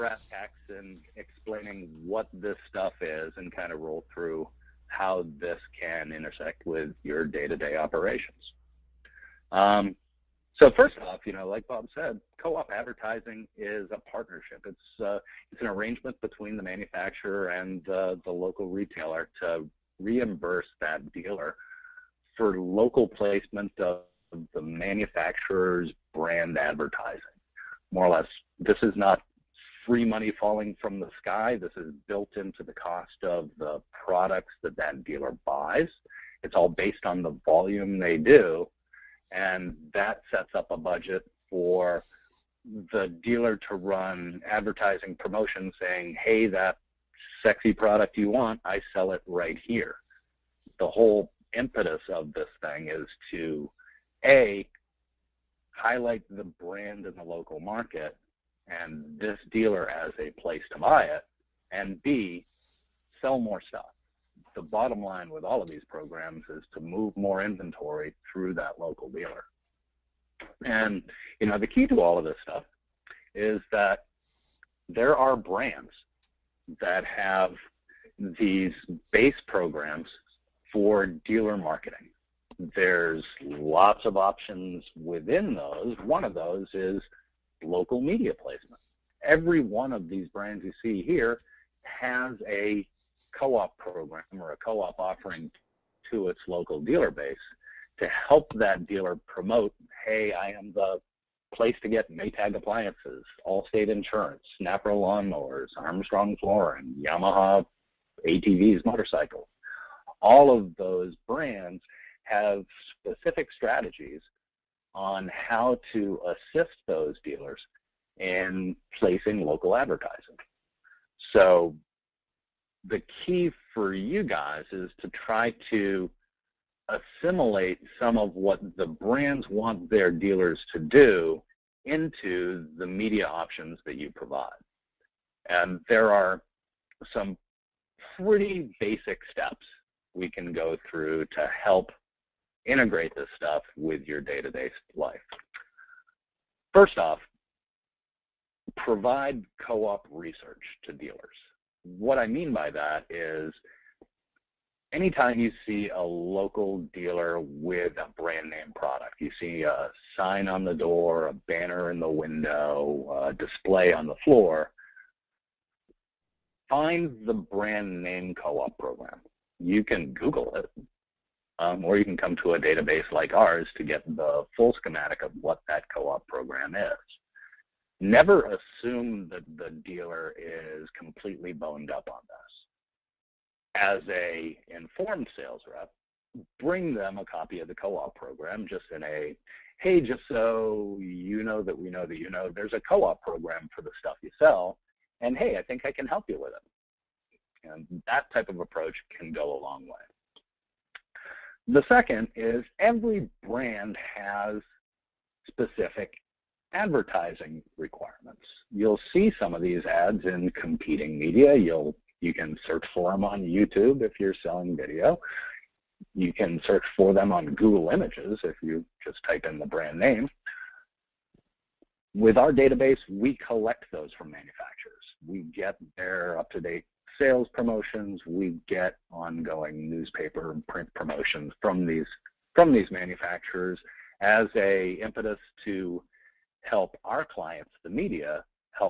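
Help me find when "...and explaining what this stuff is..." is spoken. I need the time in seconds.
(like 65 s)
0 s.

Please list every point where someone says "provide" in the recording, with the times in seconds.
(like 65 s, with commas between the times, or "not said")
134 s, 148 s.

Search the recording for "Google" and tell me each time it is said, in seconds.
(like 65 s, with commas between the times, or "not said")
170 s, 217 s.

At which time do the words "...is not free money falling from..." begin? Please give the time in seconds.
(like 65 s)
28 s.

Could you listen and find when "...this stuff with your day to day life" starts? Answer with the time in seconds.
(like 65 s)
143 s.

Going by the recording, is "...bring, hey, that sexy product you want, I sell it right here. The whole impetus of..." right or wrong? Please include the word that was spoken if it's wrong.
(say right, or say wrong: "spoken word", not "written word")
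wrong: "saying", not "bring".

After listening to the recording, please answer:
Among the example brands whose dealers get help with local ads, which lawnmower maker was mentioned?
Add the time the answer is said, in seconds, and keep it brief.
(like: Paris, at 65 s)
Snapper, at 104 s.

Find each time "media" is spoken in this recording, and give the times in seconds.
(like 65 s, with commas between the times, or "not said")
88 s, 132 s, 211 s, 237 s.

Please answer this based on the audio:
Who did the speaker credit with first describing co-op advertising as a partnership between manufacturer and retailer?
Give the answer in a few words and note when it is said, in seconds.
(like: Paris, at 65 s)
Bob, at 11 s.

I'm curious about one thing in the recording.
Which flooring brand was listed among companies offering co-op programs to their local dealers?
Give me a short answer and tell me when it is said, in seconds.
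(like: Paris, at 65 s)
Armstrong, at 105 s.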